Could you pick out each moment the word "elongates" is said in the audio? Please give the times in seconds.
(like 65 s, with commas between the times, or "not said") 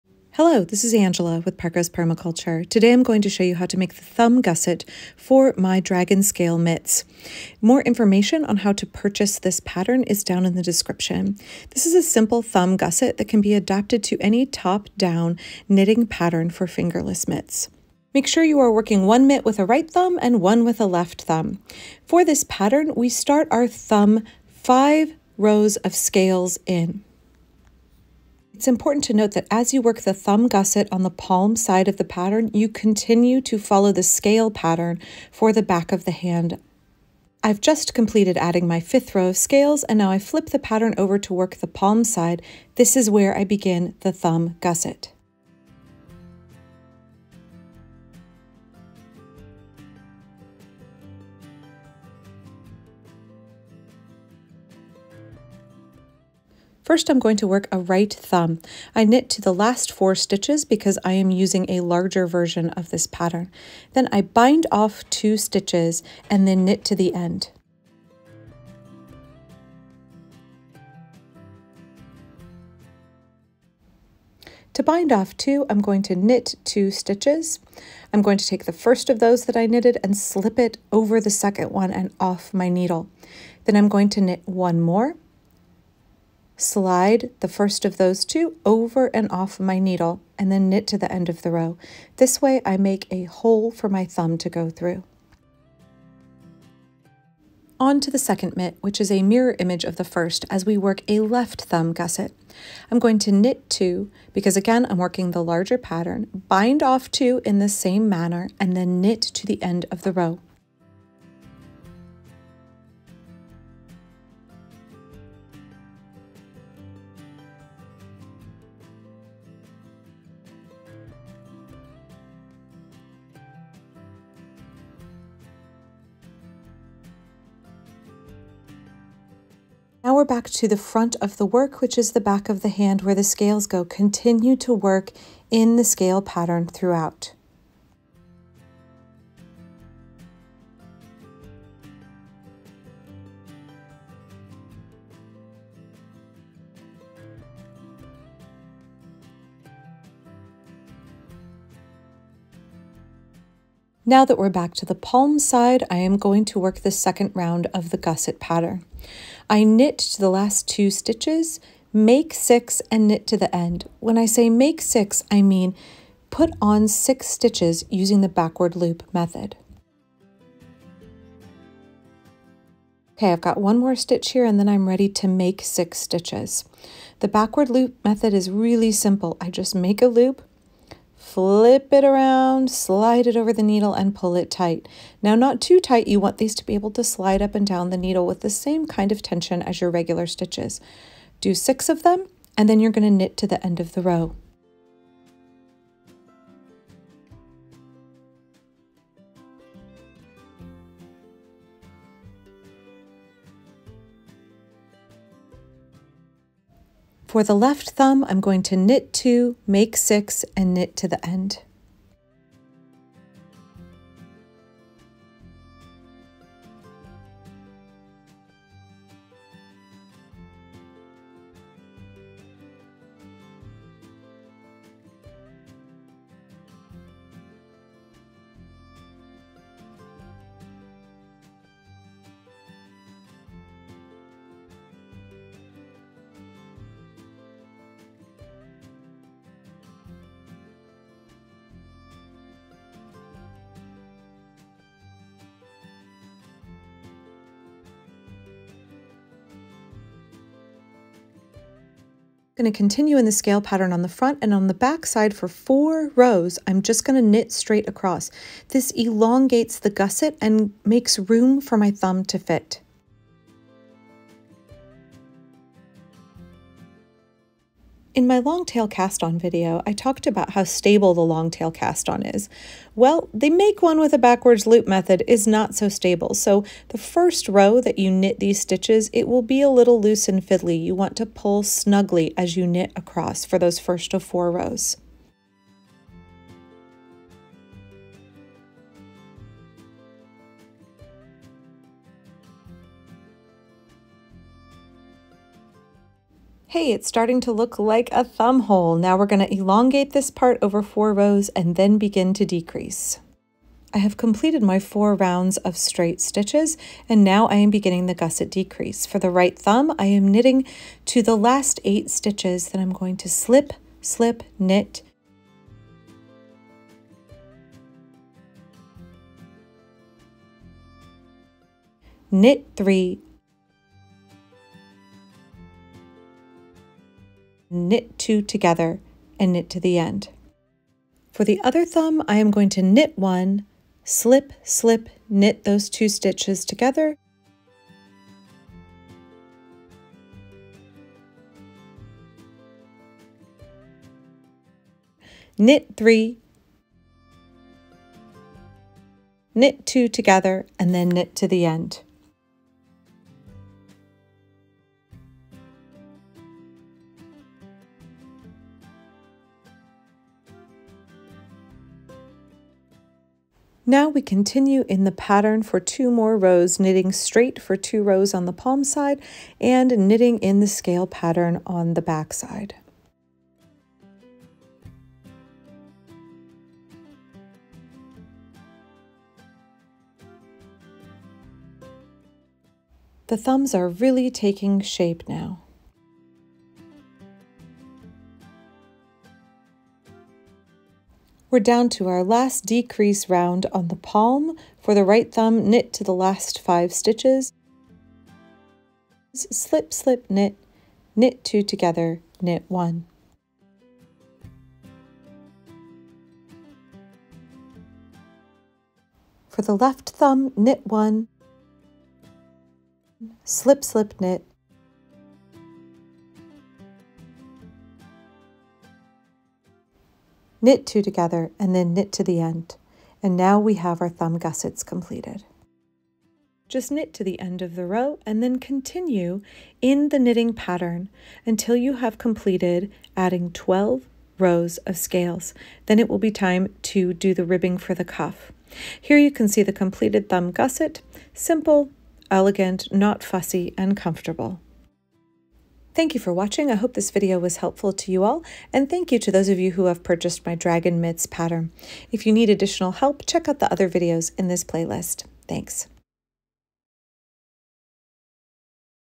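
258 s, 299 s.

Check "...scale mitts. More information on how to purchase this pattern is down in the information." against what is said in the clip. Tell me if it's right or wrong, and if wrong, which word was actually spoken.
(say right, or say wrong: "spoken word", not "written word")
wrong: "description", not "information".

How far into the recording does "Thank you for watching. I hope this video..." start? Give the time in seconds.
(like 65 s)
445 s.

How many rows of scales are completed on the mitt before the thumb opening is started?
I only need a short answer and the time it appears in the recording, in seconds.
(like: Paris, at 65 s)
5, at 24 s.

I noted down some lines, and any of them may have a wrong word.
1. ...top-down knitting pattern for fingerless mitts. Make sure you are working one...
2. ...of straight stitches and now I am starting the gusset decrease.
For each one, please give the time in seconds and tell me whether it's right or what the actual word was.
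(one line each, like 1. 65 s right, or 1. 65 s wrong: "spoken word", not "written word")
1. 14 s right
2. 305 s wrong: "beginning", not "starting".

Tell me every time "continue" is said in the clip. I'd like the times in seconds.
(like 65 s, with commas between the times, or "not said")
32 s, 133 s, 252 s, 364 s, 428 s.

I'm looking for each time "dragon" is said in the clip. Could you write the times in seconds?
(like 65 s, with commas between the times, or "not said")
5 s, 450 s.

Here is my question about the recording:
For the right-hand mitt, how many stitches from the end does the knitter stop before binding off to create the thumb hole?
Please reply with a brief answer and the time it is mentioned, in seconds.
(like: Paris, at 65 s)
4, at 59 s.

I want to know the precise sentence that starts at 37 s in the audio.
I've just completed adding my fifth row of scales and now I flip the pattern over to work the palm side.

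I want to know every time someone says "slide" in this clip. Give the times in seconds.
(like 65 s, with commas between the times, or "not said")
86 s, 182 s, 187 s.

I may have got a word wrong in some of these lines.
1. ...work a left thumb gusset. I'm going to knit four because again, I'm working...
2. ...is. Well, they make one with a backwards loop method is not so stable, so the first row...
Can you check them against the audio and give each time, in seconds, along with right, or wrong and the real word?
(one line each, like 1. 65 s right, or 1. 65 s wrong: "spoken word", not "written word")
1. 100 s wrong: "two", not "four"
2. 272 s right.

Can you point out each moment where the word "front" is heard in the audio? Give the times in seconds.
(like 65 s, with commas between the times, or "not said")
130 s, 254 s.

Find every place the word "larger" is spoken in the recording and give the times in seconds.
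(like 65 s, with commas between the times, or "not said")
61 s, 105 s.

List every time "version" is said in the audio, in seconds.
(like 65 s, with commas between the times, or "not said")
62 s.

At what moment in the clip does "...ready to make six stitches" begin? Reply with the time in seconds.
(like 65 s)
174 s.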